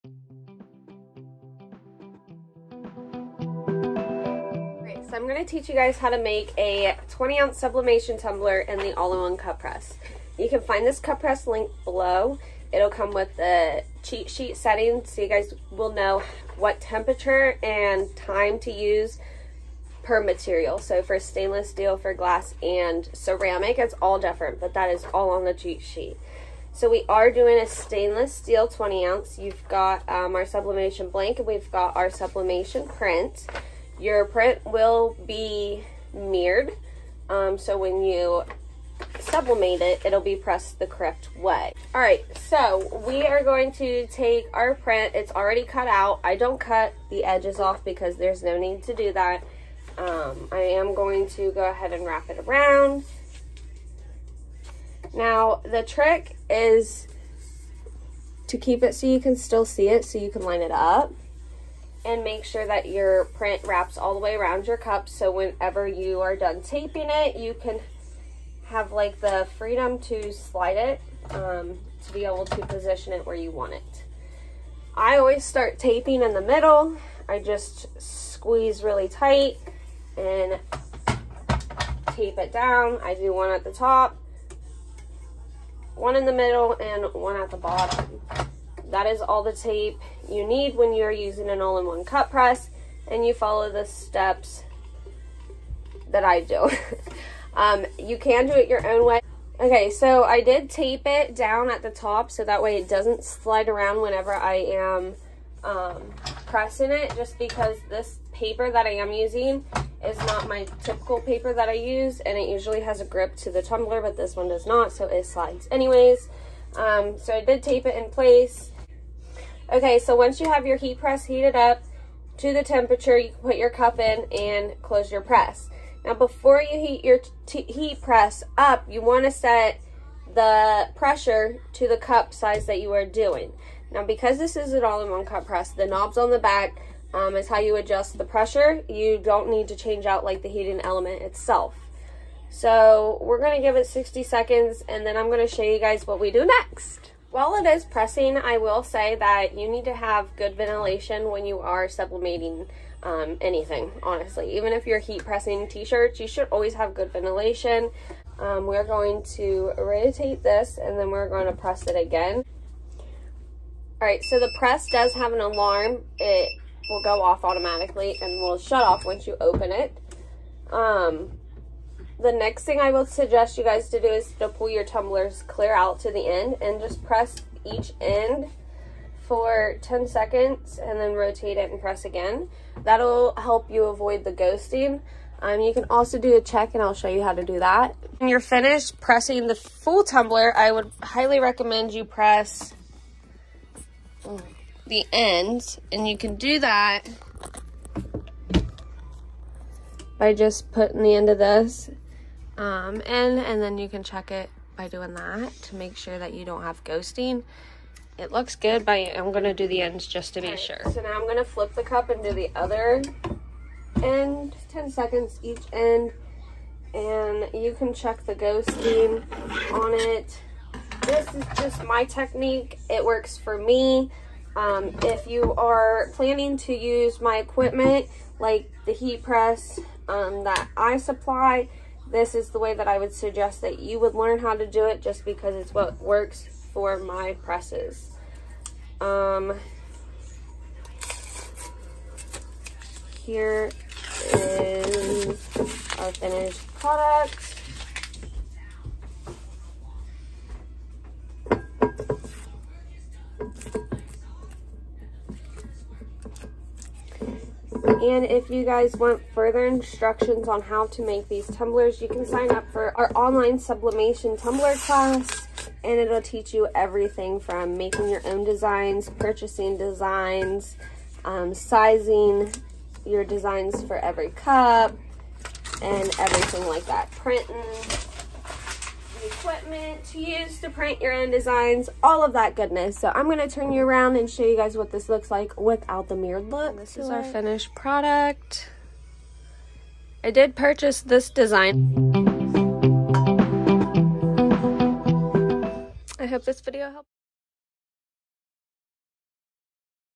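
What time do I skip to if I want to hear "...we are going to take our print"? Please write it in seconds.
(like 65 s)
43 s.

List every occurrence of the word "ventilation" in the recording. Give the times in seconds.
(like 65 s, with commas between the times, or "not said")
150 s, 157 s.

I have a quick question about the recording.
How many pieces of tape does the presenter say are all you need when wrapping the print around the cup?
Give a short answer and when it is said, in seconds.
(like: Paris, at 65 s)
3, at 83 s.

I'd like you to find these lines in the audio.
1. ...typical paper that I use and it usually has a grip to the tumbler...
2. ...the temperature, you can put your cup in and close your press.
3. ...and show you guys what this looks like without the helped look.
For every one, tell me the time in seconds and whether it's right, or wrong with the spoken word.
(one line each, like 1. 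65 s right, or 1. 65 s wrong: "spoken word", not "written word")
1. 110 s right
2. 122 s right
3. 284 s wrong: "mirrored", not "helped".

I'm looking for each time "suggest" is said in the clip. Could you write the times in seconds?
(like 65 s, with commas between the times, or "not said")
173 s, 233 s.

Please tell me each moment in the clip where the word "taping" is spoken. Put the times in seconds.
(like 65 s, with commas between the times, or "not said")
66 s, 75 s.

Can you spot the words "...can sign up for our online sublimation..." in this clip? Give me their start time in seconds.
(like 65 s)
262 s.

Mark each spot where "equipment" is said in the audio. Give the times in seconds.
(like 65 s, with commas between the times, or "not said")
227 s, 279 s.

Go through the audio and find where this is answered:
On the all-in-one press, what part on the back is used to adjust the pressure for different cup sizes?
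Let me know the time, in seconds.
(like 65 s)
135 s.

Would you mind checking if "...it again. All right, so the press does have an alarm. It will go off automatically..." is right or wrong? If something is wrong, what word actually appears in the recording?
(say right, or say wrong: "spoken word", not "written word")
right.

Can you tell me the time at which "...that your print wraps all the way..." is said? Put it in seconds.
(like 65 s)
62 s.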